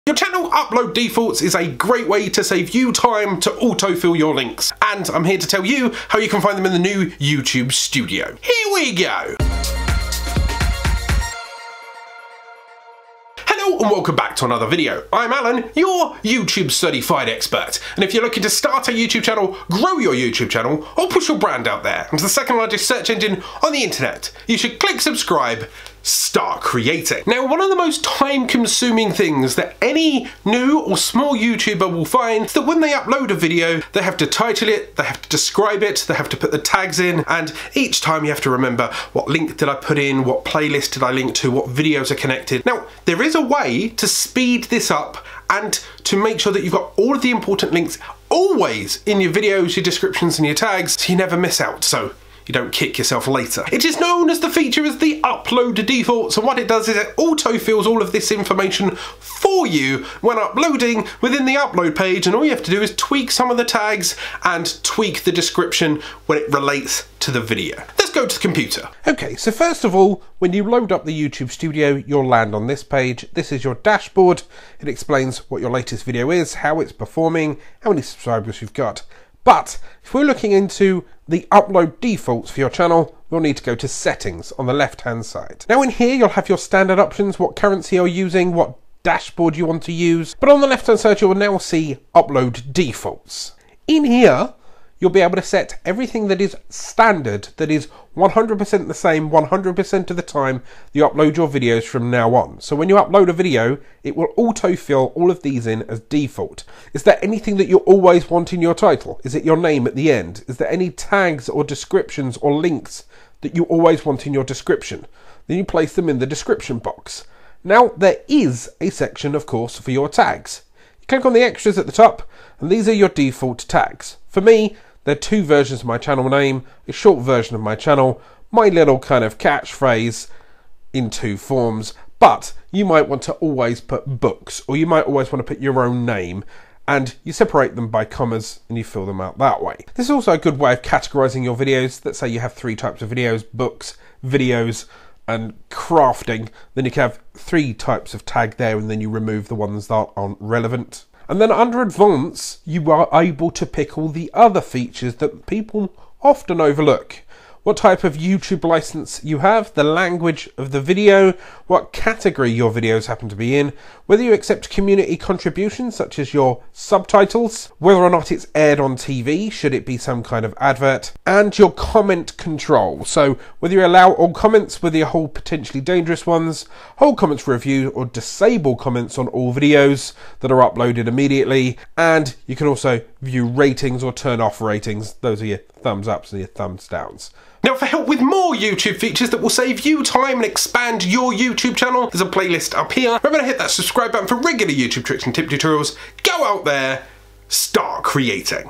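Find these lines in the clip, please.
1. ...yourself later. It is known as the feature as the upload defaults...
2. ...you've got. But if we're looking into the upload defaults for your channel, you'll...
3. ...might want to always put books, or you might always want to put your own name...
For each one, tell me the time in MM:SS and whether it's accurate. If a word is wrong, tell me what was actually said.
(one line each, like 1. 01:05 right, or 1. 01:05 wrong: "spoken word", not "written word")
1. 00:52 right
2. 01:18 right
3. 02:12 right.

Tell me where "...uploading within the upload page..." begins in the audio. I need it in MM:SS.
01:00.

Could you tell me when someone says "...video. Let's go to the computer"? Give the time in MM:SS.
01:07.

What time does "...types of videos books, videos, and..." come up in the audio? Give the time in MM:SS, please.
02:22.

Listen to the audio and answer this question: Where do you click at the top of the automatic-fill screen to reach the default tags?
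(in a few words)
Extras.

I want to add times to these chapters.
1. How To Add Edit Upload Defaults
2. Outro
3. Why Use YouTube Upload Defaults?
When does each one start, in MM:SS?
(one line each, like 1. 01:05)
1. 01:08
2. 03:07
3. 00:27.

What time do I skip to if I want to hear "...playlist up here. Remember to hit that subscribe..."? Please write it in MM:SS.
03:12.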